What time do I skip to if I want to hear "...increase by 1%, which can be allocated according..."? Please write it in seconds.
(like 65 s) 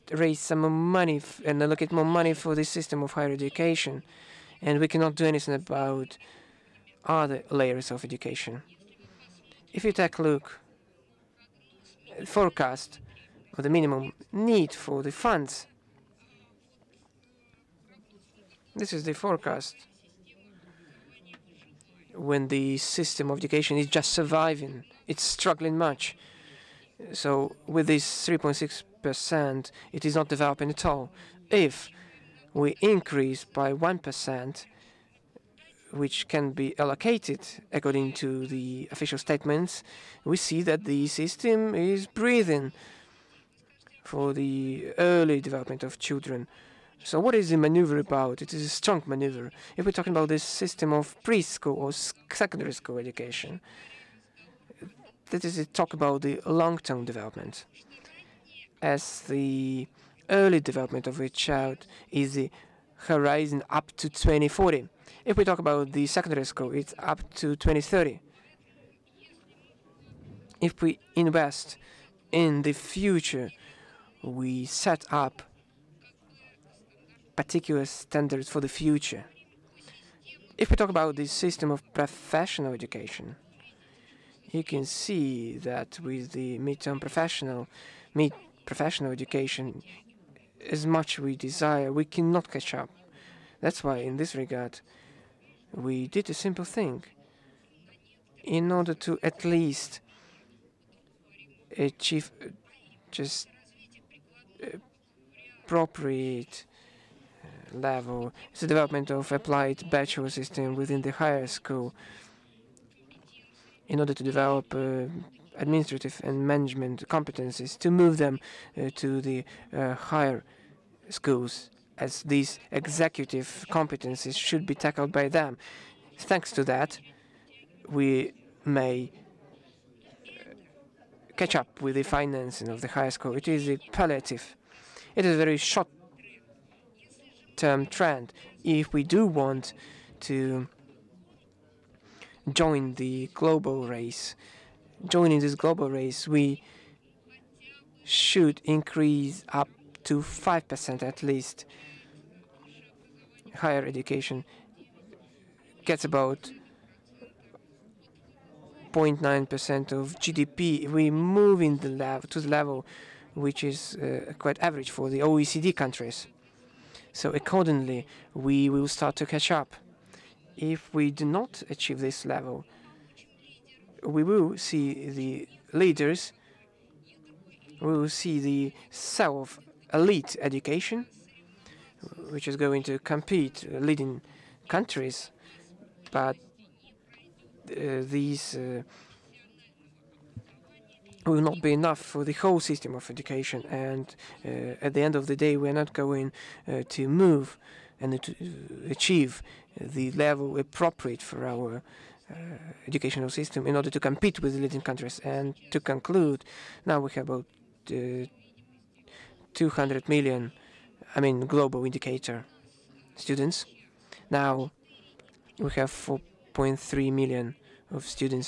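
32 s.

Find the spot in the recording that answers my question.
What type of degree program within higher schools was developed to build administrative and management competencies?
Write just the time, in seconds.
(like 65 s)
109 s.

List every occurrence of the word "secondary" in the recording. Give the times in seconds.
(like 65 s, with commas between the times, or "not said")
52 s, 66 s.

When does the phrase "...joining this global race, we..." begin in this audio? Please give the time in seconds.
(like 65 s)
145 s.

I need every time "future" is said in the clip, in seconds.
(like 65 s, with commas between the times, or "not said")
72 s, 78 s.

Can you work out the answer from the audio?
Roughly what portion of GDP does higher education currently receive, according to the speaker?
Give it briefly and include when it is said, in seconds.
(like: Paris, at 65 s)
0.9%, at 158 s.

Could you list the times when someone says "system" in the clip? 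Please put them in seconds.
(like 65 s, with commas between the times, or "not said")
2 s, 22 s, 41 s, 50 s, 81 s, 110 s, 192 s, 203 s.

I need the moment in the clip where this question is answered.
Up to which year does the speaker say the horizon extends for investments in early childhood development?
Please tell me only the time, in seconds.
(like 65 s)
64 s.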